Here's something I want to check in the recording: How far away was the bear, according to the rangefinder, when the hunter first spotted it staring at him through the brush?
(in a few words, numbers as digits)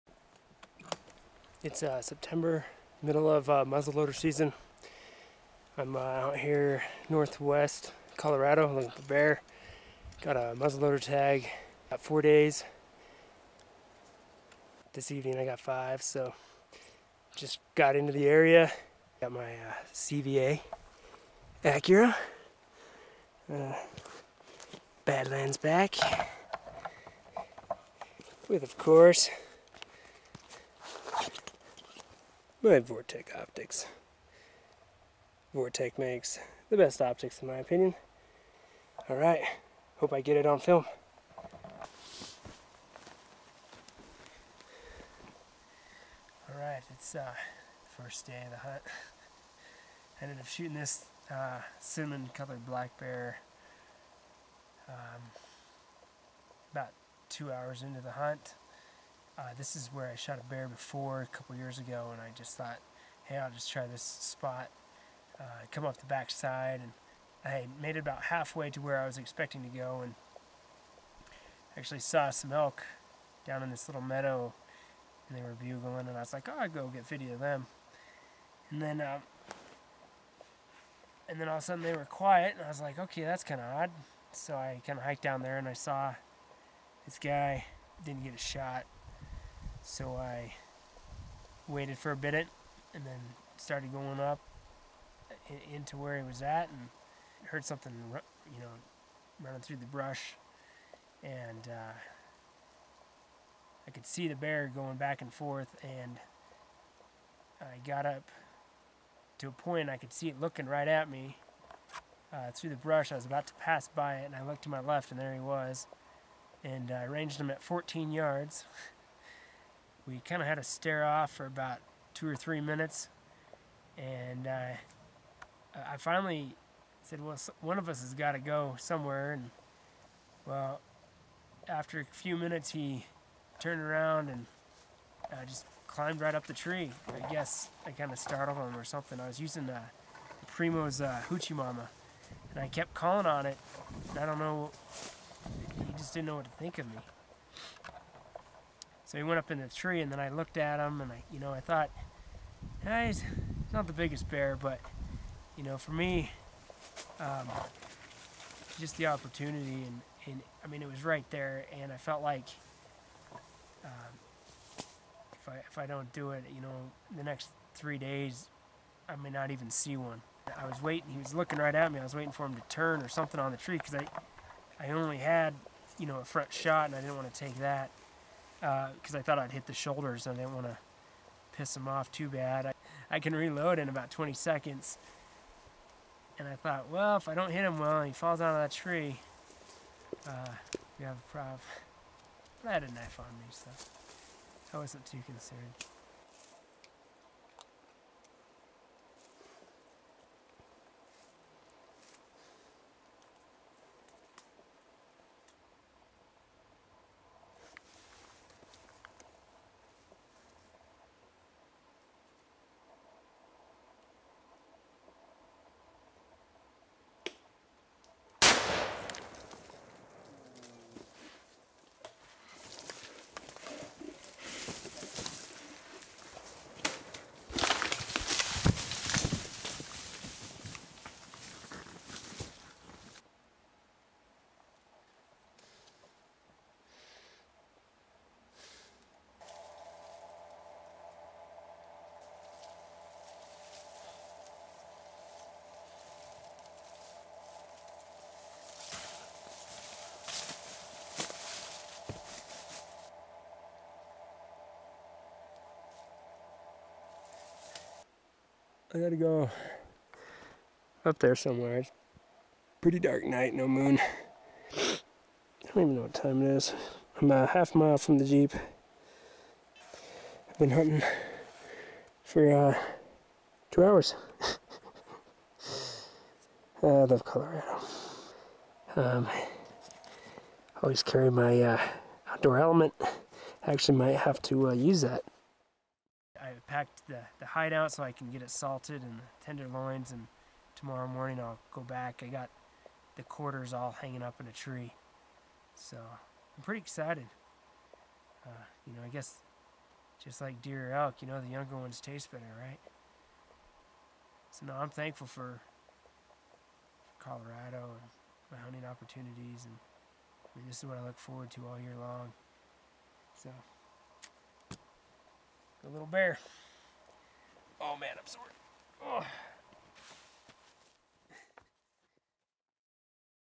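14 yards.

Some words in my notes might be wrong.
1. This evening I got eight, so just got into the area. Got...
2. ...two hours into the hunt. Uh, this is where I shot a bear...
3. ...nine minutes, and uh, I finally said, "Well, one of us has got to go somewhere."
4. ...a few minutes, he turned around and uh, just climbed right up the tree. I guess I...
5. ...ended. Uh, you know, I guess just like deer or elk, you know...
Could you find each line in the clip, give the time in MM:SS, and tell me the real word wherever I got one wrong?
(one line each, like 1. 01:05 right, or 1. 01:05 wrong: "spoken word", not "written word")
1. 00:14 wrong: "five", not "eight"
2. 00:57 right
3. 02:02 wrong: "three", not "nine"
4. 02:11 right
5. 04:56 wrong: "excited", not "ended".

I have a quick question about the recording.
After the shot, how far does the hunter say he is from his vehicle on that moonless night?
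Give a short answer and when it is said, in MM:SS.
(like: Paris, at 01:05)
a half mile, at 04:27.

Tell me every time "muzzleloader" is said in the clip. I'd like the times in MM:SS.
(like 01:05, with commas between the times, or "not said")
00:03, 00:10.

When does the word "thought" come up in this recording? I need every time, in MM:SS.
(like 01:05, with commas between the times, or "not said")
01:02, 02:31, 02:59, 03:06.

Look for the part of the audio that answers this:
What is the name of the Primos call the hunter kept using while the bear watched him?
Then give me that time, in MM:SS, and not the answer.
02:21.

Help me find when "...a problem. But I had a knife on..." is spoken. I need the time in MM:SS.
03:11.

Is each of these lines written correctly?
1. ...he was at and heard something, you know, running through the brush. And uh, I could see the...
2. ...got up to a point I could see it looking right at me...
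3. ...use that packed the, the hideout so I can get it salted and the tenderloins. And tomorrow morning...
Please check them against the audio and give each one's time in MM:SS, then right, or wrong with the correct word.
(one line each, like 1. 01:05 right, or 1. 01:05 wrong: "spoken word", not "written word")
1. 01:36 right
2. 01:47 right
3. 04:44 right.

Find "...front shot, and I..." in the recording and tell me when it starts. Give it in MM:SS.
02:56.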